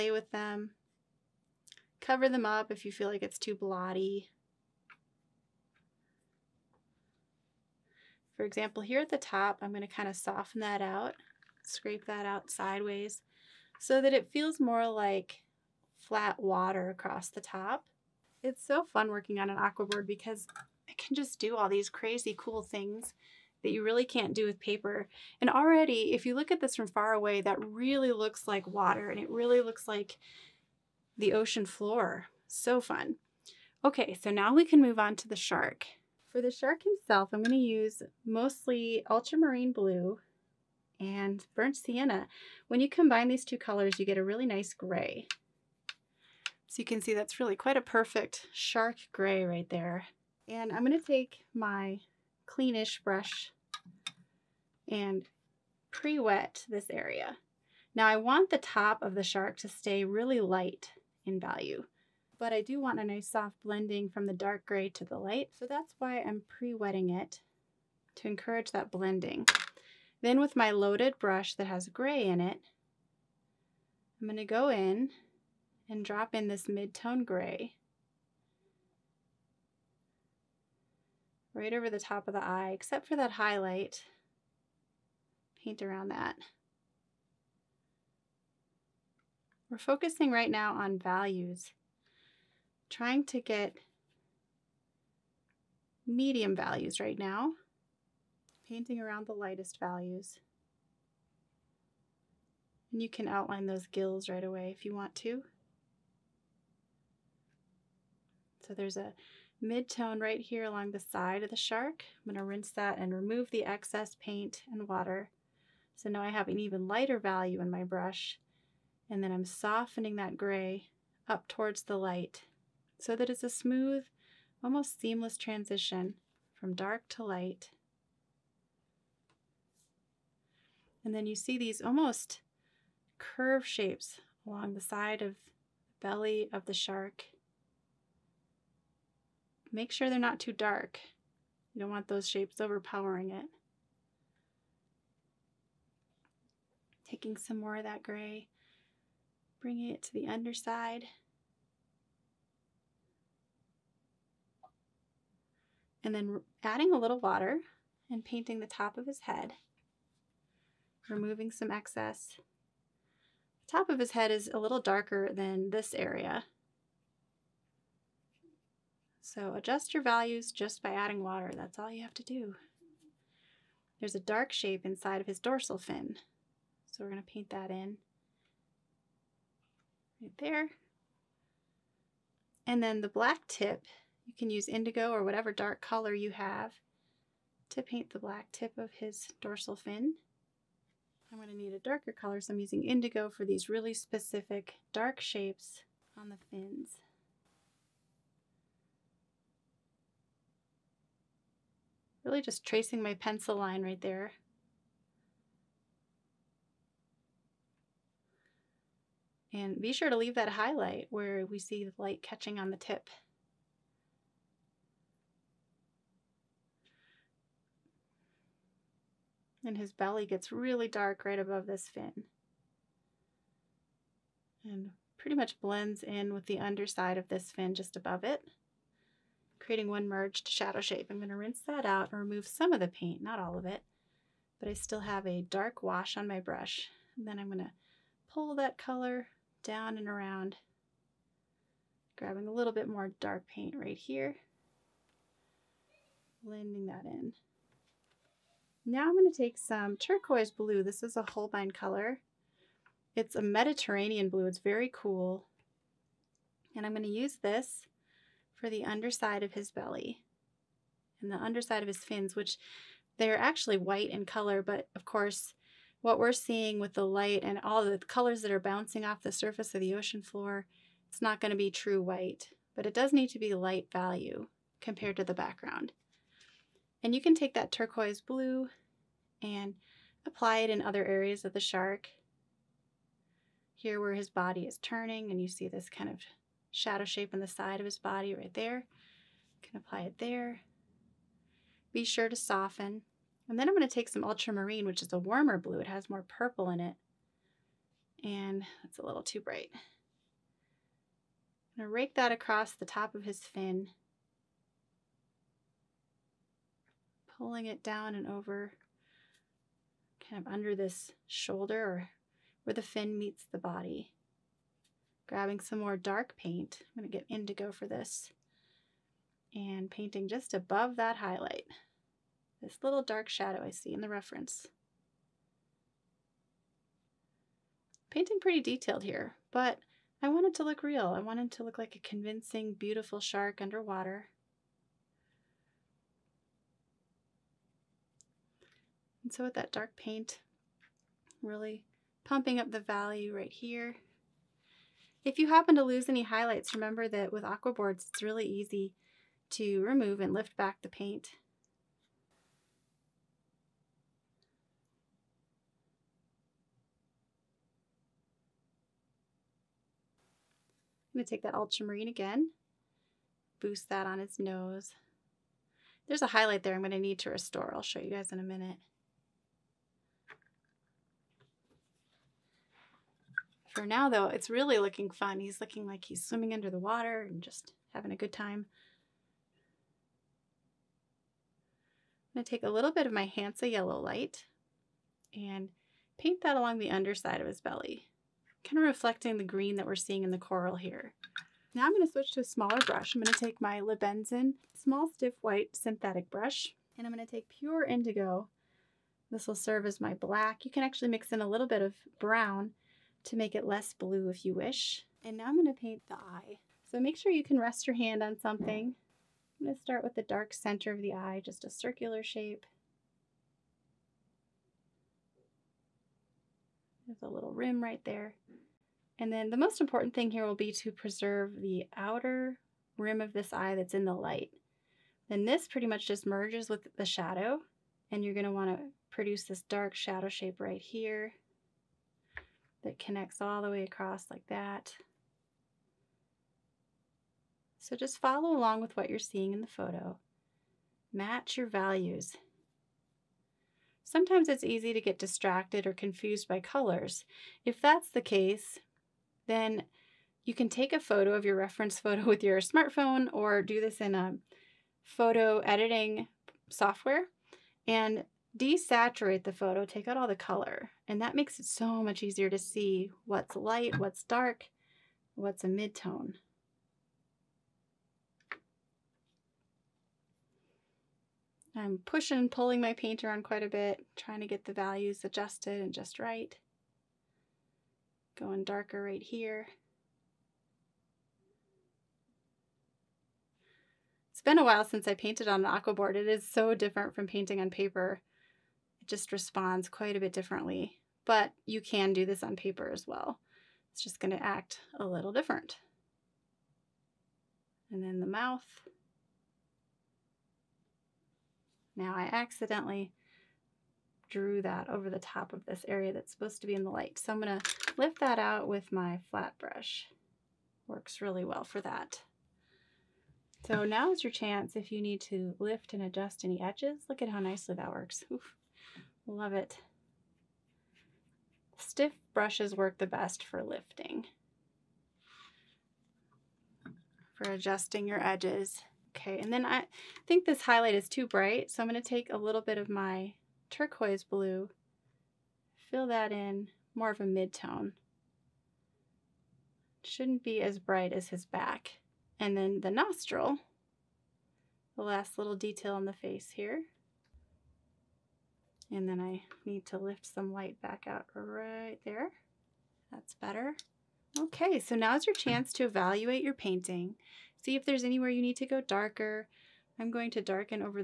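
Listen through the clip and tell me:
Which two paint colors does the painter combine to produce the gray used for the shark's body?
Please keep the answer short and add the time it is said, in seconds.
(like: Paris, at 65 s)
Ultramarine blue and burnt sienna, at 39 s.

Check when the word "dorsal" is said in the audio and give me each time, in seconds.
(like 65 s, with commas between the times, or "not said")
175 s, 189 s.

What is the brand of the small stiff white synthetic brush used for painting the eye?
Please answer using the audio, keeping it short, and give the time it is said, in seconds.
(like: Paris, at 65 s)
Lebenzon, at 393 s.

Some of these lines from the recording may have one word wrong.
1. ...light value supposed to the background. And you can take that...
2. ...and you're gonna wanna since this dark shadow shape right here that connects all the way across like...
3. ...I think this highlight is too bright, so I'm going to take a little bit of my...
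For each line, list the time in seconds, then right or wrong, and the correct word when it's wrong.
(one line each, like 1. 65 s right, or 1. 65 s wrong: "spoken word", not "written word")
1. 273 s wrong: "compared", not "supposed"
2. 428 s wrong: "produce", not "since"
3. 529 s right.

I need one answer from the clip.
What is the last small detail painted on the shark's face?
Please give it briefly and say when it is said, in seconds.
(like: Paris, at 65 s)
The nostril, at 542 s.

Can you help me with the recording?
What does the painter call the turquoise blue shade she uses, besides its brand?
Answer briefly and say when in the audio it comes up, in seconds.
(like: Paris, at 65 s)
Mediterranean blue, at 253 s.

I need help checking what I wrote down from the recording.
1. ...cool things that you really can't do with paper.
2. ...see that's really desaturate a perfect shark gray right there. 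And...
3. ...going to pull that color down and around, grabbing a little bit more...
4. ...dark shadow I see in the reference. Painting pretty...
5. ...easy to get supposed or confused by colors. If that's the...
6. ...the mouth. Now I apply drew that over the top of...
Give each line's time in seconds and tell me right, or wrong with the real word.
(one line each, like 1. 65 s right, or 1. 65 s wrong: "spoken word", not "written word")
1. 22 s right
2. 47 s wrong: "quite", not "desaturate"
3. 237 s right
4. 323 s right
5. 444 s wrong: "distracted", not "supposed"
6. 498 s wrong: "accidentally", not "apply".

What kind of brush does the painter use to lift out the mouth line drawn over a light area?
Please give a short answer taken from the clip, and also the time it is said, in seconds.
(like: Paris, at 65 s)
Flat brush, at 509 s.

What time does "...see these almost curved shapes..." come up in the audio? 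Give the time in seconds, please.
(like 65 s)
131 s.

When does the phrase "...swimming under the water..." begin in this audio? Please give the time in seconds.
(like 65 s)
376 s.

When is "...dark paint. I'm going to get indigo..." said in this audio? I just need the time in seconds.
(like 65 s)
315 s.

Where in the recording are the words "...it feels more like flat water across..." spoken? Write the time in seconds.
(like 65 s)
14 s.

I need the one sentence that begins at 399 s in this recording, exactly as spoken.
This will serve as my black.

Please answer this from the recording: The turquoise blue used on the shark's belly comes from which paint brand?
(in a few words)
Holbein.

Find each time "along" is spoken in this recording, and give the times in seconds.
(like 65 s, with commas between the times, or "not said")
110 s, 134 s, 386 s, 438 s.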